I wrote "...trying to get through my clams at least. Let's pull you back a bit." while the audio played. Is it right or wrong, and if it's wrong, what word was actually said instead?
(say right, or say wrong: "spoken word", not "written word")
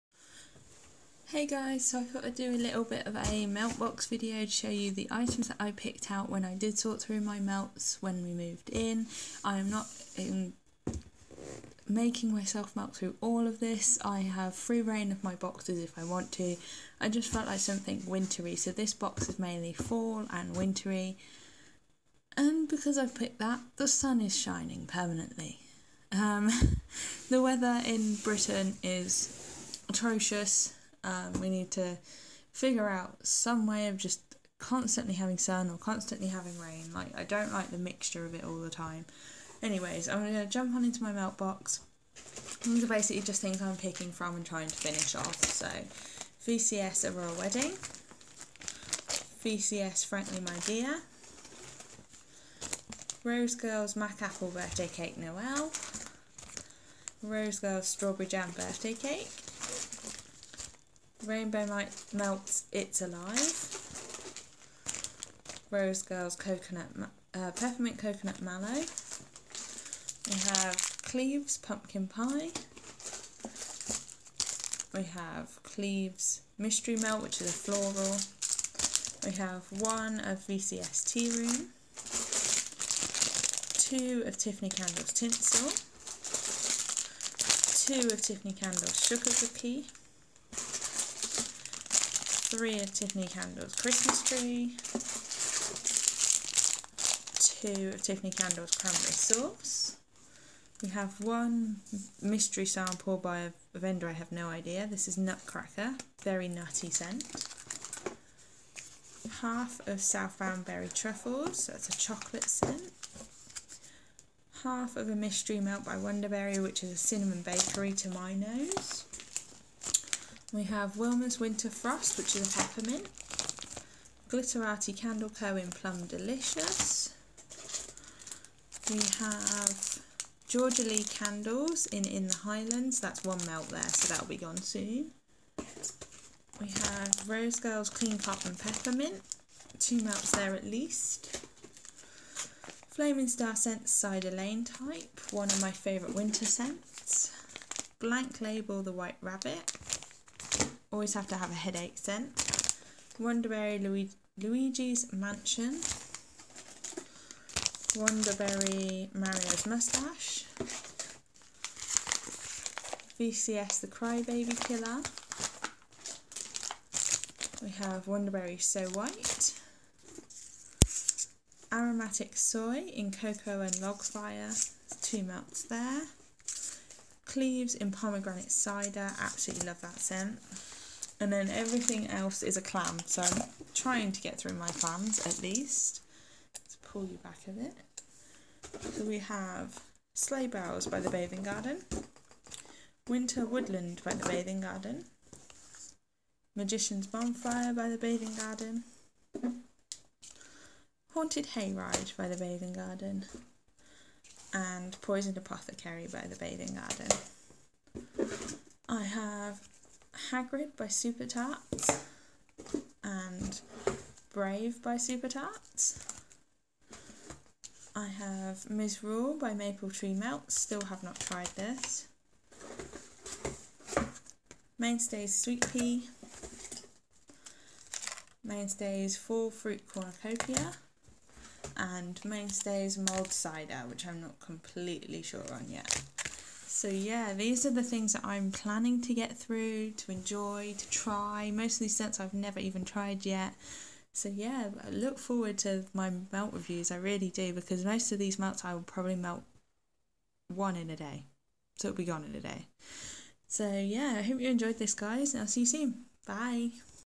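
right.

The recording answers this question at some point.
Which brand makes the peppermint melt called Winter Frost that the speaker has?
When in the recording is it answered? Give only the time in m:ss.
2:00.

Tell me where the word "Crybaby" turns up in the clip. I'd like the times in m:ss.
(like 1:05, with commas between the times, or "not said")
2:43.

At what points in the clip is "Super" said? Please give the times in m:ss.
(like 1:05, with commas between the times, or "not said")
3:30, 3:34.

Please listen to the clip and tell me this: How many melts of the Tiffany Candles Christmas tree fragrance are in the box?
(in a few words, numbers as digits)
3.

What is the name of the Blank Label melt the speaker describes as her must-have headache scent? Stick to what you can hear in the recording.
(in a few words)
The White Rabbit.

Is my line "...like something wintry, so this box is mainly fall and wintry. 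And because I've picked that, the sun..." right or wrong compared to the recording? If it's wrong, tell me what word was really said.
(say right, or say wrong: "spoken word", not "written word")
right.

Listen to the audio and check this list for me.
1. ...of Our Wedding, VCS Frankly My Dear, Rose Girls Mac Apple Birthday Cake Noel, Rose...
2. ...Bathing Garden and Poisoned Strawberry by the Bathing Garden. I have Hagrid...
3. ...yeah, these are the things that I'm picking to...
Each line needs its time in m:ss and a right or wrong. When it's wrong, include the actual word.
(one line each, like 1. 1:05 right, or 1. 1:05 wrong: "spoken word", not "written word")
1. 0:47 right
2. 3:22 wrong: "Apothecary", not "Strawberry"
3. 3:56 wrong: "planning", not "picking".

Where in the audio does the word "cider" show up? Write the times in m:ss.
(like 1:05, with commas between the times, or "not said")
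2:23, 2:58, 3:53.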